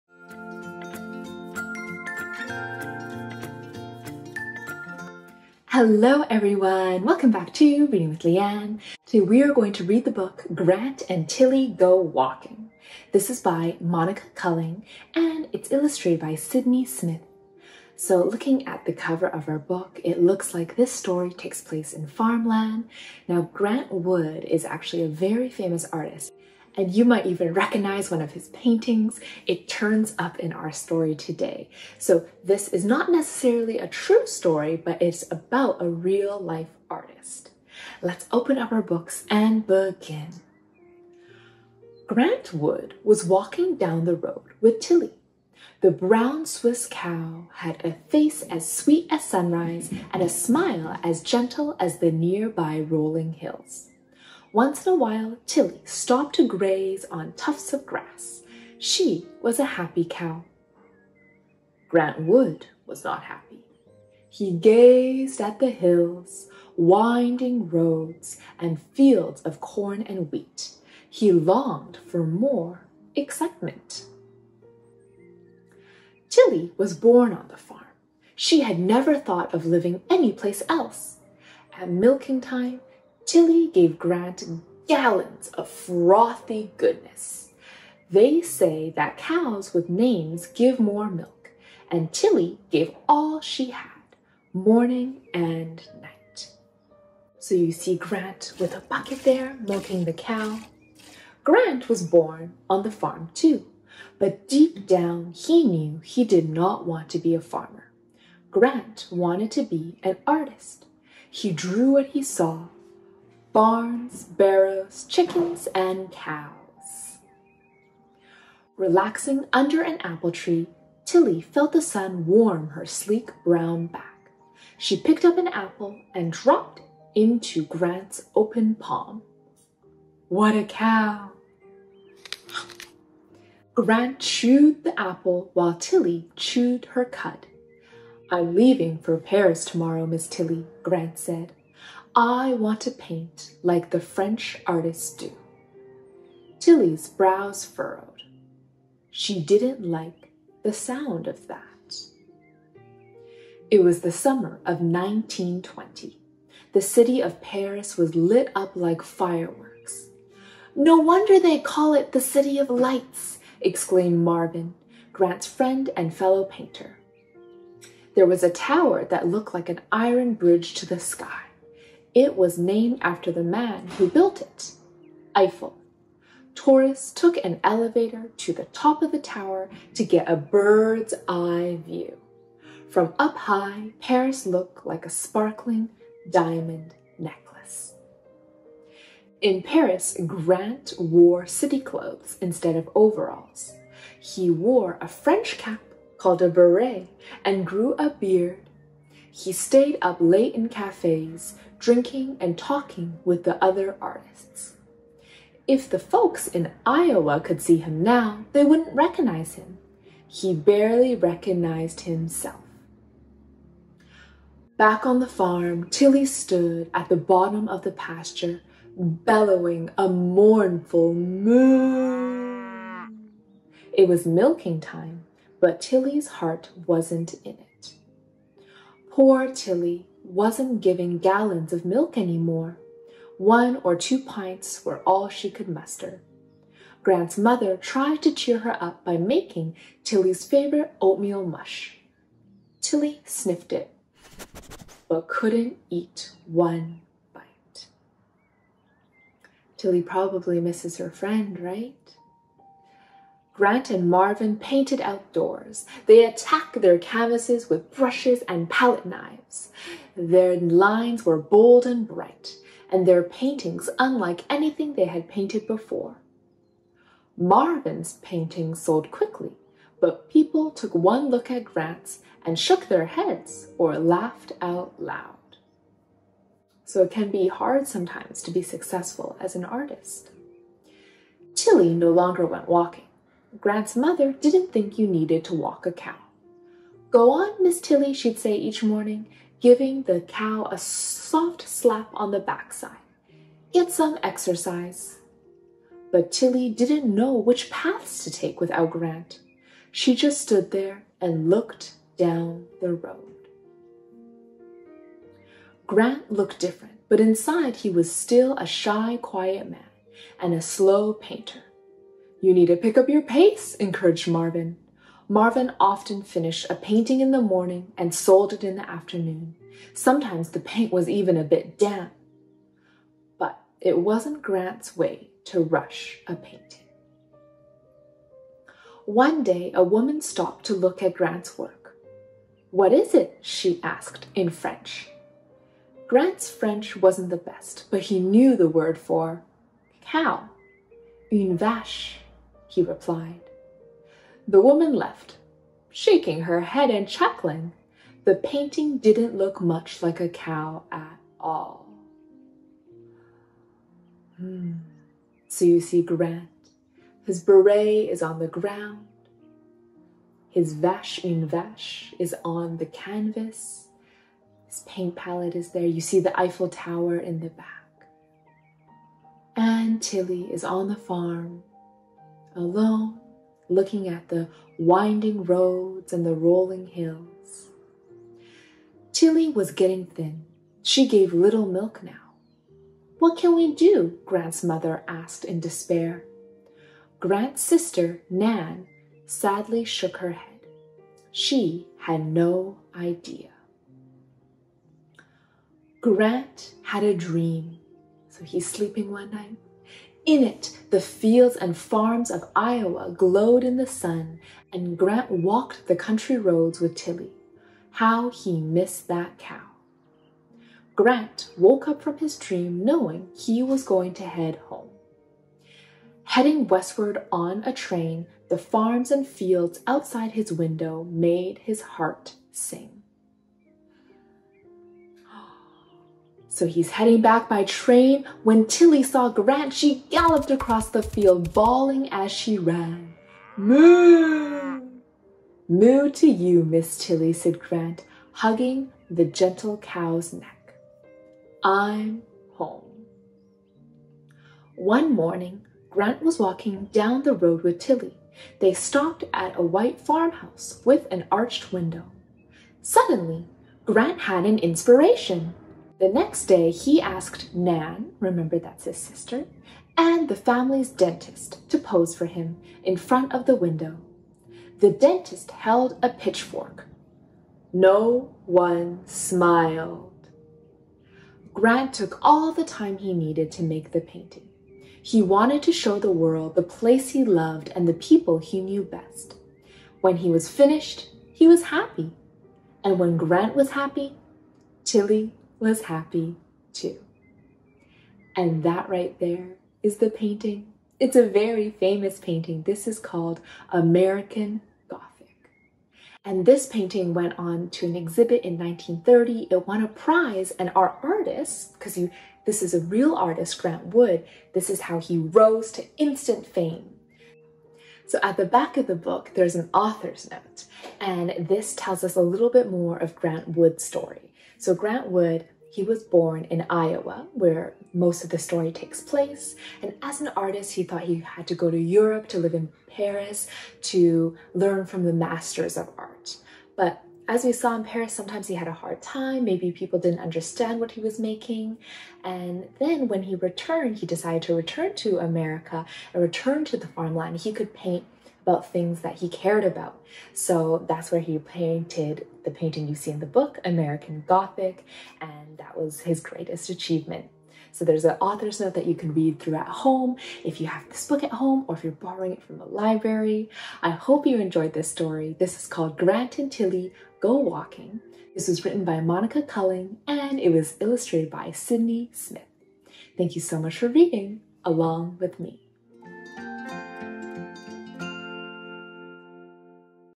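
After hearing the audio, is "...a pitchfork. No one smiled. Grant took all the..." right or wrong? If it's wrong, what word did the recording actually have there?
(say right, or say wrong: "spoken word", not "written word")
right.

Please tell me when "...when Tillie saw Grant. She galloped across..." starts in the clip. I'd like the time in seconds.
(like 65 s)
428 s.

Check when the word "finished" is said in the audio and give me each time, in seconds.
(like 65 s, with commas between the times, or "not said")
316 s, 480 s.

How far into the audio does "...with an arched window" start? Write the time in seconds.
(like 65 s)
450 s.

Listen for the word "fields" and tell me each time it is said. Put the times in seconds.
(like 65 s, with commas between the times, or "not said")
68 s, 401 s, 419 s, 431 s.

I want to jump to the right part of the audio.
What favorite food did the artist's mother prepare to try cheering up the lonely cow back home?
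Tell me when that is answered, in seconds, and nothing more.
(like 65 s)
241 s.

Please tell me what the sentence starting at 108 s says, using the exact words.
Grant wanted to be an artist.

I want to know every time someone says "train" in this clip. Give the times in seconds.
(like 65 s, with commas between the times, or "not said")
417 s, 427 s.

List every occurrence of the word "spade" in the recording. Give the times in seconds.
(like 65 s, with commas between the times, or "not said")
not said.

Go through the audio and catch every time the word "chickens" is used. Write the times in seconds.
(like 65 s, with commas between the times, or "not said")
115 s.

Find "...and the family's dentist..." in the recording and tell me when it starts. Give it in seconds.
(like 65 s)
459 s.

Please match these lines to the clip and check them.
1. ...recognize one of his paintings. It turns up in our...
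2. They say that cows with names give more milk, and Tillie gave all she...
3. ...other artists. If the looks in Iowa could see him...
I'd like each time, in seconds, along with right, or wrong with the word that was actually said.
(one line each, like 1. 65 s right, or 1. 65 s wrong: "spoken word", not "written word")
1. 27 s right
2. 88 s right
3. 203 s wrong: "folks", not "looks".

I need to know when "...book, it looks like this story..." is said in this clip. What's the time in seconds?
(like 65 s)
19 s.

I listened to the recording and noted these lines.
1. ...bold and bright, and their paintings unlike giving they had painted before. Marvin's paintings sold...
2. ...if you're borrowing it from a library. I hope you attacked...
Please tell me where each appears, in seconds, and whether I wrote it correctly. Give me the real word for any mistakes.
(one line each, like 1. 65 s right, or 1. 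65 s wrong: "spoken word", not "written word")
1. 261 s wrong: "anything", not "giving"
2. 551 s wrong: "enjoyed", not "attacked".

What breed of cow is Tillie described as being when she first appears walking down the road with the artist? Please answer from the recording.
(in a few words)
Brown Swiss.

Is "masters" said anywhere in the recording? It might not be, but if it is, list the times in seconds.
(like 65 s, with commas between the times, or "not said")
525 s.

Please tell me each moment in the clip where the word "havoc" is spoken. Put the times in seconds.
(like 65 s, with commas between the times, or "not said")
not said.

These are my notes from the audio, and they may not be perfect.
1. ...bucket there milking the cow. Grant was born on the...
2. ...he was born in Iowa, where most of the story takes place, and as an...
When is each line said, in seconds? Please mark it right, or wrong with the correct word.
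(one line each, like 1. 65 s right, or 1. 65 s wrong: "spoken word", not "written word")
1. 98 s right
2. 515 s right.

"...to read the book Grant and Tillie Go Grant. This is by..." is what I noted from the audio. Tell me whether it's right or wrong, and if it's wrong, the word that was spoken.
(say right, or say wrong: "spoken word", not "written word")
wrong: "Walking", not "Grant".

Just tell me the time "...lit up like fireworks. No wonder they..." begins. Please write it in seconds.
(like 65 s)
158 s.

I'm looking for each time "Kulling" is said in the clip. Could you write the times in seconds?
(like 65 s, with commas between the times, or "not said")
14 s, 559 s.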